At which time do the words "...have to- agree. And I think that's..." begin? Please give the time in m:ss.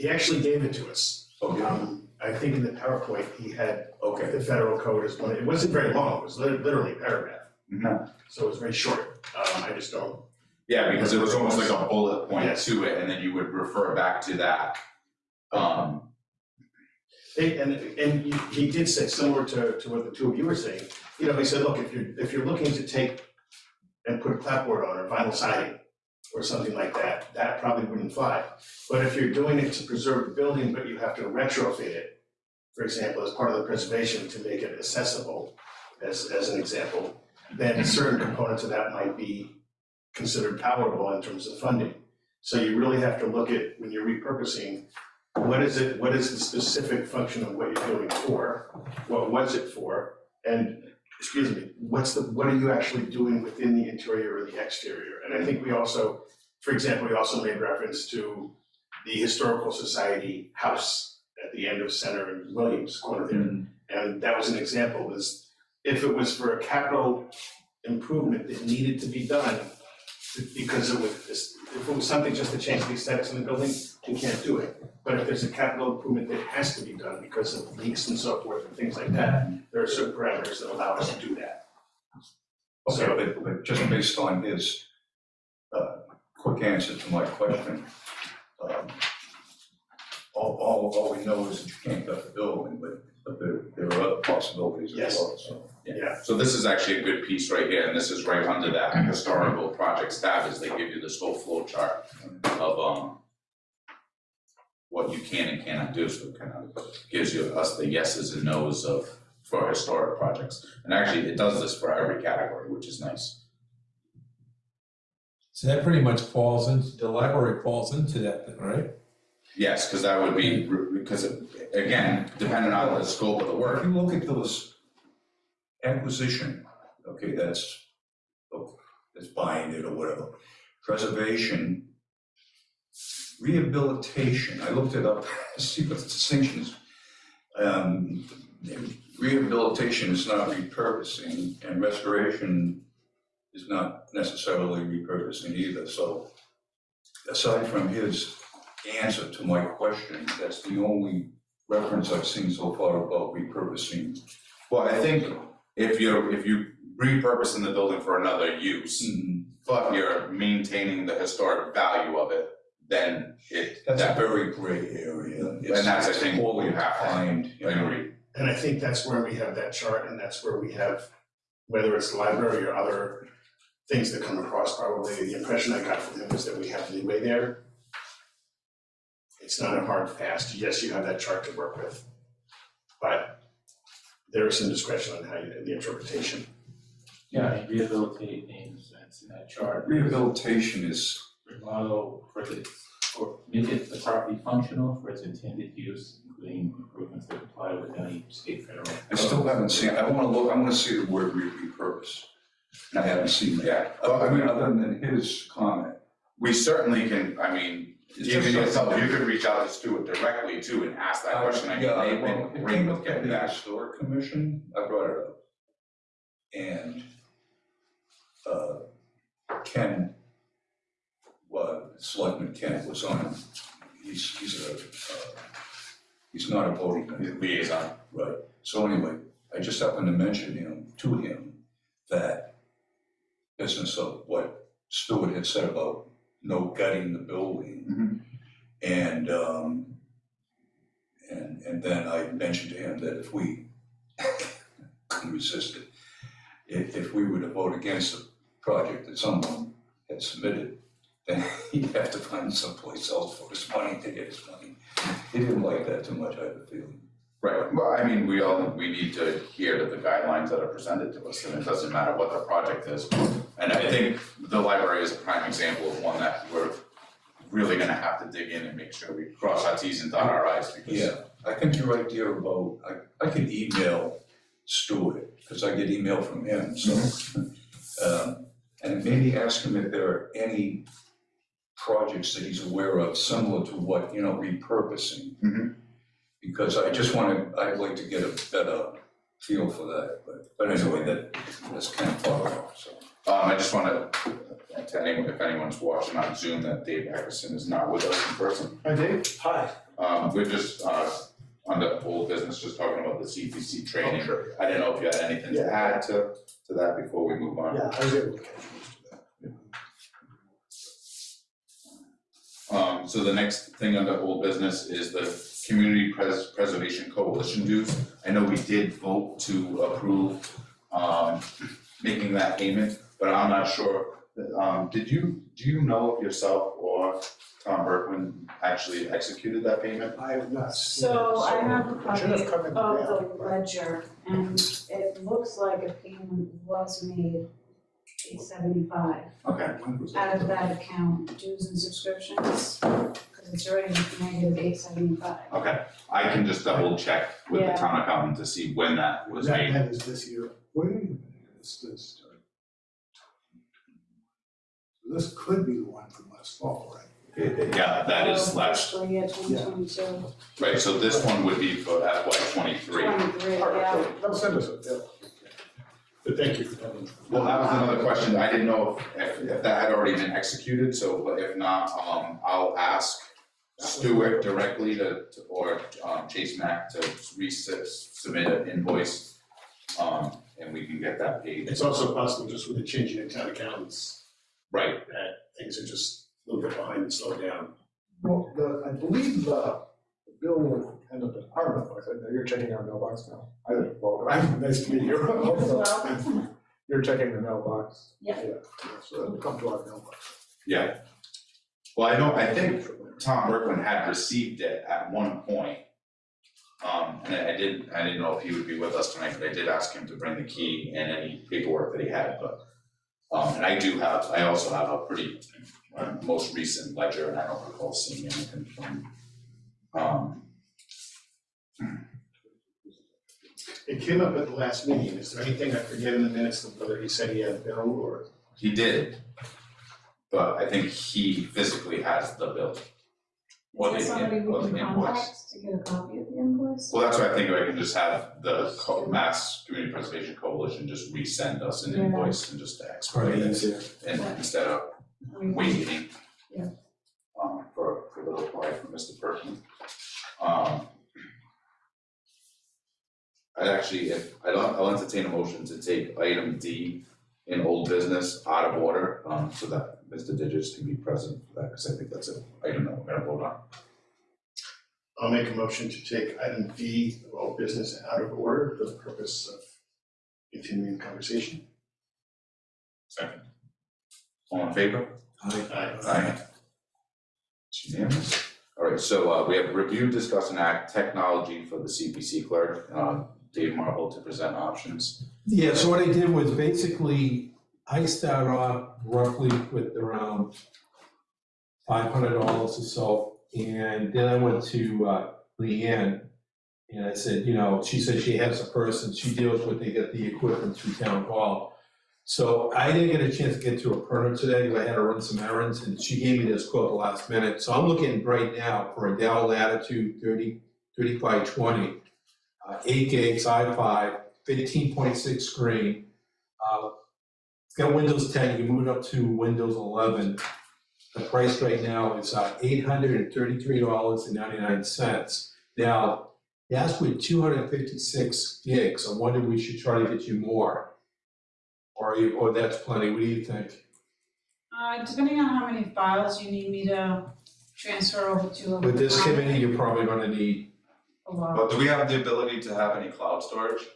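2:46.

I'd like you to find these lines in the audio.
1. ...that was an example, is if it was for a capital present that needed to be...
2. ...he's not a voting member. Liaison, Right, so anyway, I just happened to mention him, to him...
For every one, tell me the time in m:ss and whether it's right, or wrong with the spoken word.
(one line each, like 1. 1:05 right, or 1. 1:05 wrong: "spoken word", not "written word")
1. 1:04 wrong: "improvement", not "present"
2. 3:46 right.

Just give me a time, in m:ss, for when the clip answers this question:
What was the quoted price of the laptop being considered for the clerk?
8:42.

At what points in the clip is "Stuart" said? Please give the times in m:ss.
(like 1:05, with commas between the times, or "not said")
3:29, 4:34, 6:13.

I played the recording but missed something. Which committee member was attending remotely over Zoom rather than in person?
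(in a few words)
Dave Eckerson.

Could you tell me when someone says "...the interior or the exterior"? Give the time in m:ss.
0:53.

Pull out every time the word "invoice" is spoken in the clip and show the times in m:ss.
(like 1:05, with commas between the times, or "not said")
6:18, 7:16, 7:21.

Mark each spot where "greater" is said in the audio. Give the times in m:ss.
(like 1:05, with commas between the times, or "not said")
not said.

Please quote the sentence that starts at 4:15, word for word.
He didn't like that too much, I have a feeling.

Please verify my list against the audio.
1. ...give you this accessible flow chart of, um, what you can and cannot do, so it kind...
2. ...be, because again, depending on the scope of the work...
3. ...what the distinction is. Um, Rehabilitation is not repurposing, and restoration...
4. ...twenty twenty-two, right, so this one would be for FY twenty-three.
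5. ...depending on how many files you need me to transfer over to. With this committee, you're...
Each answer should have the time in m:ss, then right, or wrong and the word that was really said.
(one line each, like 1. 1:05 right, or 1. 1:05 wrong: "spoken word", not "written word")
1. 1:40 wrong: "whole", not "accessible"
2. 2:00 right
3. 2:15 right
4. 5:59 right
5. 8:55 right.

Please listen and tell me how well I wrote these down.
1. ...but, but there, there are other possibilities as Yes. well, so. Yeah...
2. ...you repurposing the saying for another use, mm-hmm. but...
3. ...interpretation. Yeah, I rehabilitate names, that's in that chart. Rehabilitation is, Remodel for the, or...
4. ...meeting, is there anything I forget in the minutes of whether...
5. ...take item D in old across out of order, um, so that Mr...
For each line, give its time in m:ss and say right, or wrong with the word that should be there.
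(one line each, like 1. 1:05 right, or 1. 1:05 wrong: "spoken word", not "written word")
1. 1:32 right
2. 2:36 wrong: "building", not "saying"
3. 3:05 right
4. 7:04 right
5. 7:35 wrong: "business", not "across".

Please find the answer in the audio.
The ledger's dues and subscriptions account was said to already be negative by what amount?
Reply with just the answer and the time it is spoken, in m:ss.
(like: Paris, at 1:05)
875, at 5:44.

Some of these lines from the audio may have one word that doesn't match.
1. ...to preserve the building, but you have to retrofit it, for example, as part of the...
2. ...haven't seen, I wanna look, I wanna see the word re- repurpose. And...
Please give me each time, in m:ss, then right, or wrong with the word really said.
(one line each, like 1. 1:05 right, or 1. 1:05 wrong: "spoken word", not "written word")
1. 0:29 right
2. 3:19 right.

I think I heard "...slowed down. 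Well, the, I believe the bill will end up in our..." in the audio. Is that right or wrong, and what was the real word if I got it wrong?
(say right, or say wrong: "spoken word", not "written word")
right.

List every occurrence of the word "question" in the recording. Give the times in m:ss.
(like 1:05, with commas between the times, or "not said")
1:27, 2:29, 3:31, 6:08.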